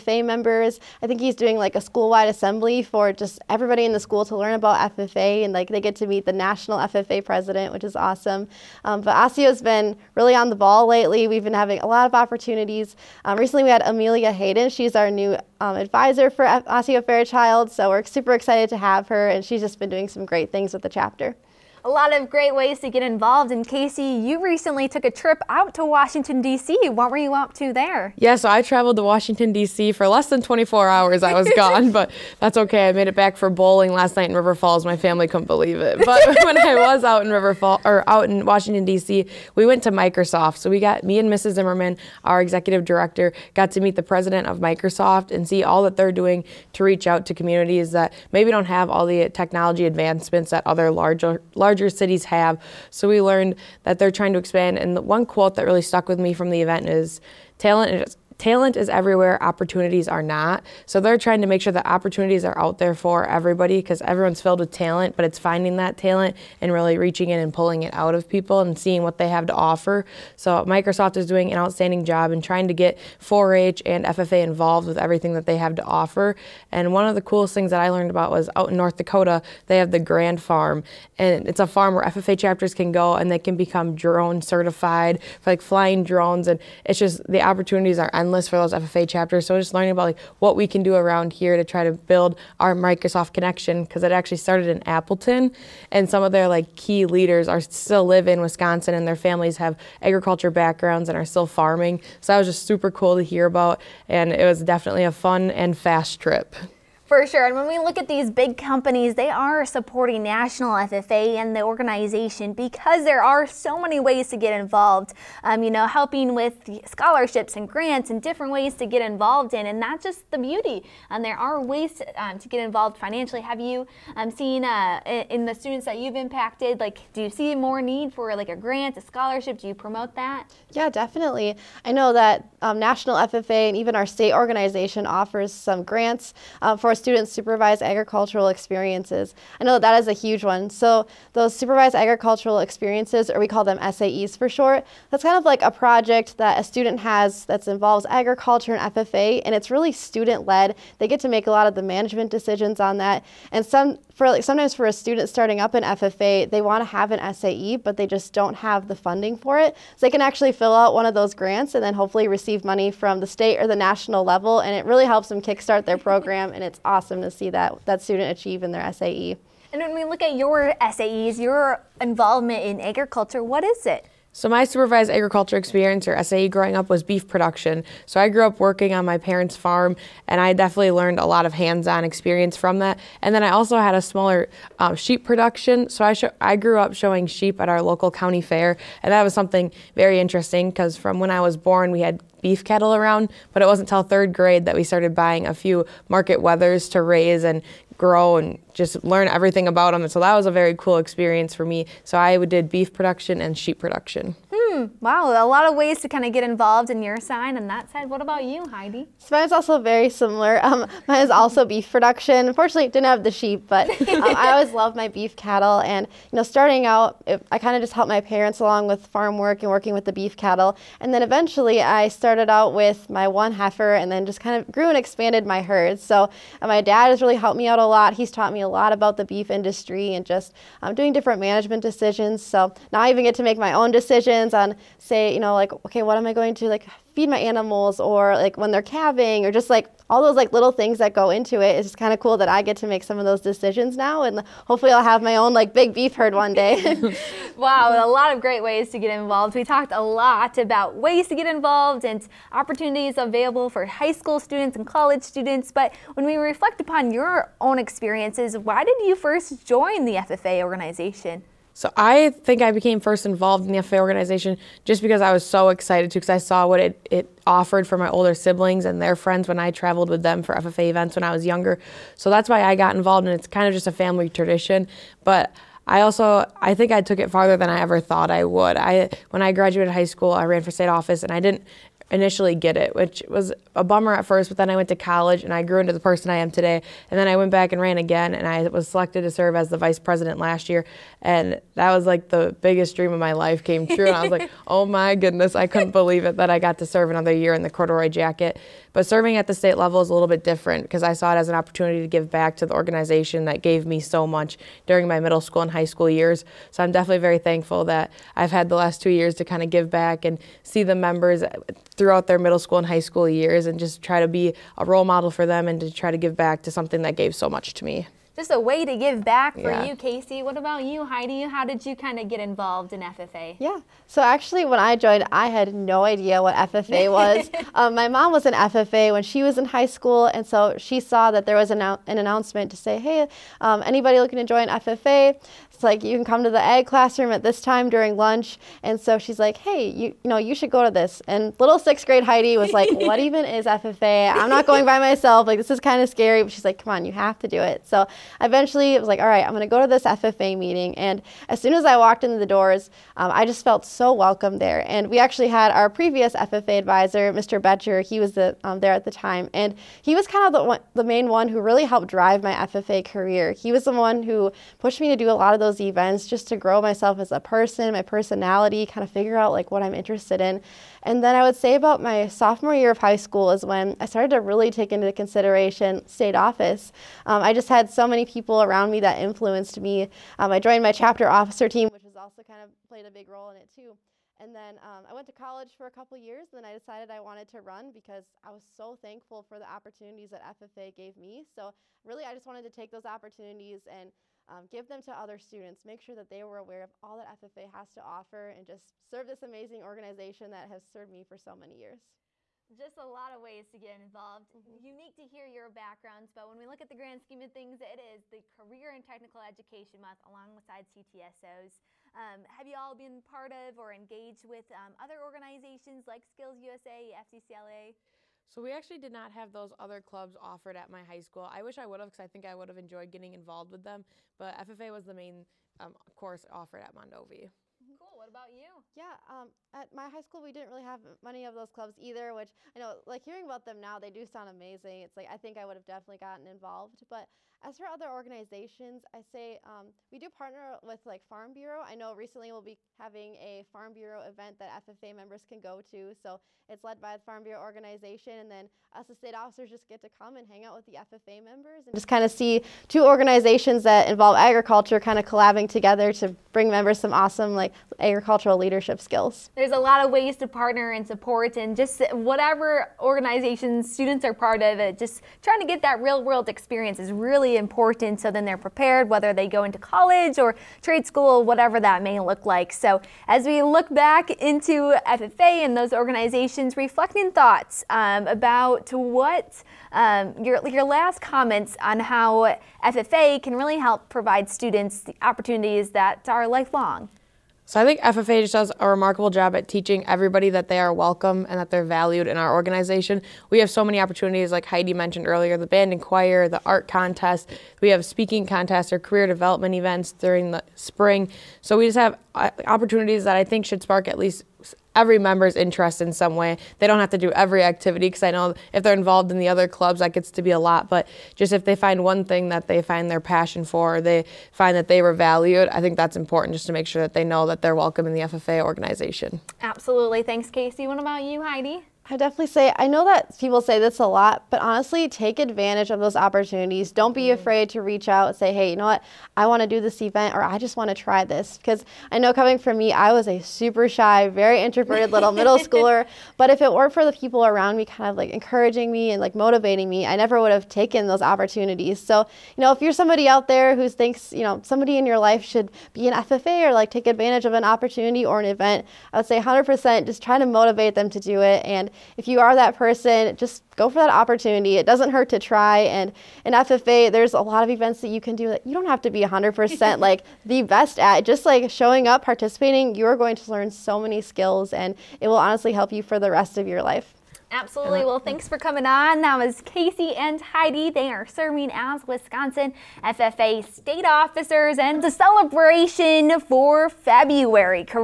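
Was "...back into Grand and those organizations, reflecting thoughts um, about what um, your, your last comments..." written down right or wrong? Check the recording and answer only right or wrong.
wrong.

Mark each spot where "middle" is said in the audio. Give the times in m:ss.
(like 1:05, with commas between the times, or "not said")
5:05, 5:12, 8:55.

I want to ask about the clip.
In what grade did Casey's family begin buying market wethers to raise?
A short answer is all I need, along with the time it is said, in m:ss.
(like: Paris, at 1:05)
Third grade, at 3:14.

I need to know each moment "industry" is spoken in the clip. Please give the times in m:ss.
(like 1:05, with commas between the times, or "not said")
3:49.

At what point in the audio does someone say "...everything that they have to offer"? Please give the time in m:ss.
1:14.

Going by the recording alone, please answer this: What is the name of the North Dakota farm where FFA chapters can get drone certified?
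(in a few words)
Grand Farm.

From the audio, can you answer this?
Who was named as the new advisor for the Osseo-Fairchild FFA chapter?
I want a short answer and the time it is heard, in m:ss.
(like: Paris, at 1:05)
Amelia Hayden, at 0:13.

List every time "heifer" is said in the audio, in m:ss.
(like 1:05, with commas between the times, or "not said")
3:43.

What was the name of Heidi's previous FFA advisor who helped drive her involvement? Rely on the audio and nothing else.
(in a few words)
Mr. Betcher.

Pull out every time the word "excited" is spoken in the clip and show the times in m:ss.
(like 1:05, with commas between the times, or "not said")
0:18, 4:25.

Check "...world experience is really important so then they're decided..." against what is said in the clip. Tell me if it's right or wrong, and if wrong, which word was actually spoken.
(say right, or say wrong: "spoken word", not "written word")
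wrong: "prepared", not "decided".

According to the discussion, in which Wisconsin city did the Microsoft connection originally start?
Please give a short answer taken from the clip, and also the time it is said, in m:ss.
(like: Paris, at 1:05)
Appleton, at 1:34.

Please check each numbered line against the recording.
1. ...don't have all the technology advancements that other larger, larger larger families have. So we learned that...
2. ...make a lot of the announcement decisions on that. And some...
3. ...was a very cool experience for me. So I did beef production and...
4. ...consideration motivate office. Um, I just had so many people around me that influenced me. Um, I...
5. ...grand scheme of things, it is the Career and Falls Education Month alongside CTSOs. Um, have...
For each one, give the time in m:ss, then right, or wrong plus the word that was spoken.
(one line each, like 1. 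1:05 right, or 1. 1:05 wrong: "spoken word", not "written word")
1. 0:48 wrong: "cities", not "families"
2. 2:31 wrong: "management", not "announcement"
3. 3:20 right
4. 6:15 wrong: "state", not "motivate"
5. 6:47 wrong: "Technical", not "Falls".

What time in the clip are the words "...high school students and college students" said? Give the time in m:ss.
4:13.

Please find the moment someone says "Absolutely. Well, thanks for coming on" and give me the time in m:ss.
9:27.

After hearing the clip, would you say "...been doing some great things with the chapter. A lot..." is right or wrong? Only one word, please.
right.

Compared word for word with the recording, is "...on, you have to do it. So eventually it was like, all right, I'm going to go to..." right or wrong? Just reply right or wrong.
right.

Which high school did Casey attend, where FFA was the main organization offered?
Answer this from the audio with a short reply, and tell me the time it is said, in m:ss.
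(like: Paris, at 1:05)
Mondovi, at 7:06.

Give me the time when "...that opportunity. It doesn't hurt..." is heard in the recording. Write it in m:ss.
9:13.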